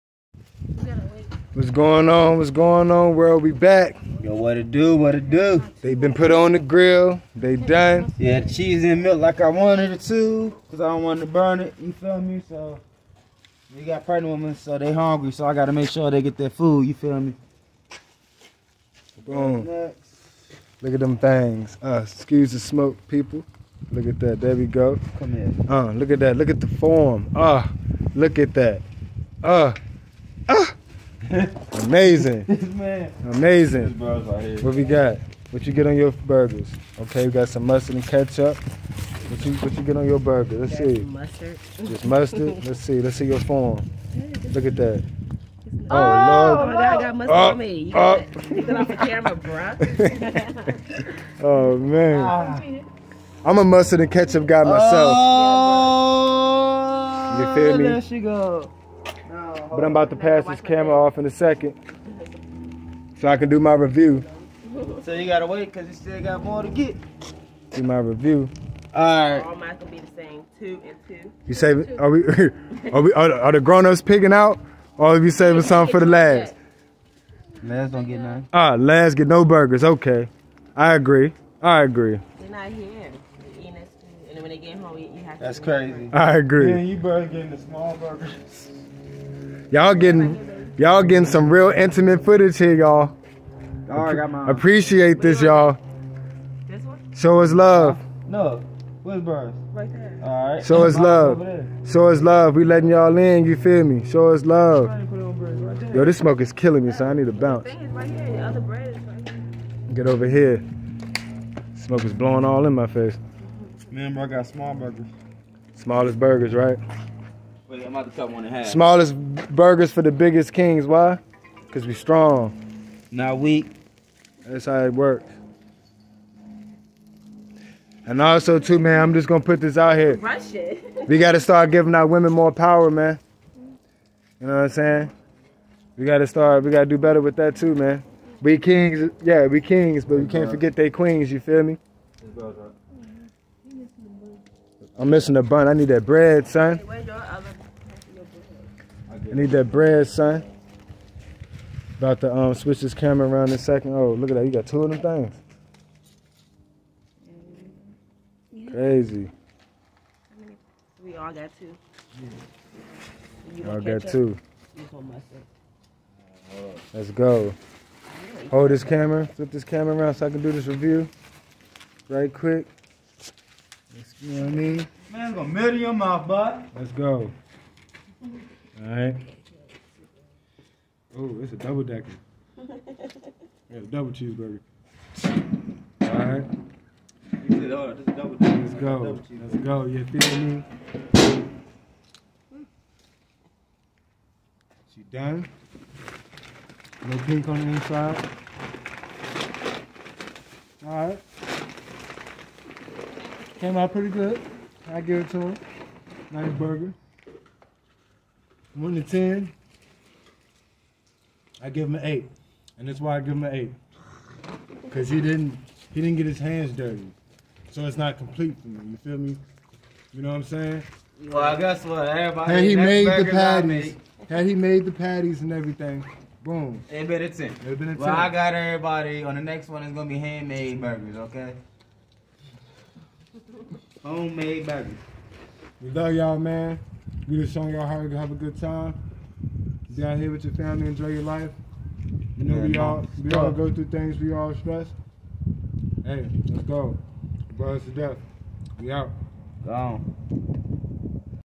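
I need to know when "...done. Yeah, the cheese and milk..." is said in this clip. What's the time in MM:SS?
00:07.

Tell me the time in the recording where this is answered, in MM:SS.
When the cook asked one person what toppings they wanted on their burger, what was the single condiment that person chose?
00:41.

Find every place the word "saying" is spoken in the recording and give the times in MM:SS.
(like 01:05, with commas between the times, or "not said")
02:14, 03:40.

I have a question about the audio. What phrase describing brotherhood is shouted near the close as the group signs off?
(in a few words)
Brothers to death.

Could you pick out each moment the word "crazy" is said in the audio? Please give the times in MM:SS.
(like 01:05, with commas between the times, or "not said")
01:25, 02:38.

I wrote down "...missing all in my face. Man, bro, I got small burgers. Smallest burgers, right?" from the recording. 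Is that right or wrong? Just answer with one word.
wrong.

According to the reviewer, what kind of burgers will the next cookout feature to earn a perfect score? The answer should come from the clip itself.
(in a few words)
Handmade burgers.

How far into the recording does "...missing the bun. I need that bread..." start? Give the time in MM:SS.
02:25.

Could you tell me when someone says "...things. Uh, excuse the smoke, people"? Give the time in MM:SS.
00:21.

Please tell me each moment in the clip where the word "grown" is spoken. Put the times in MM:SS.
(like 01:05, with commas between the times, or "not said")
01:13.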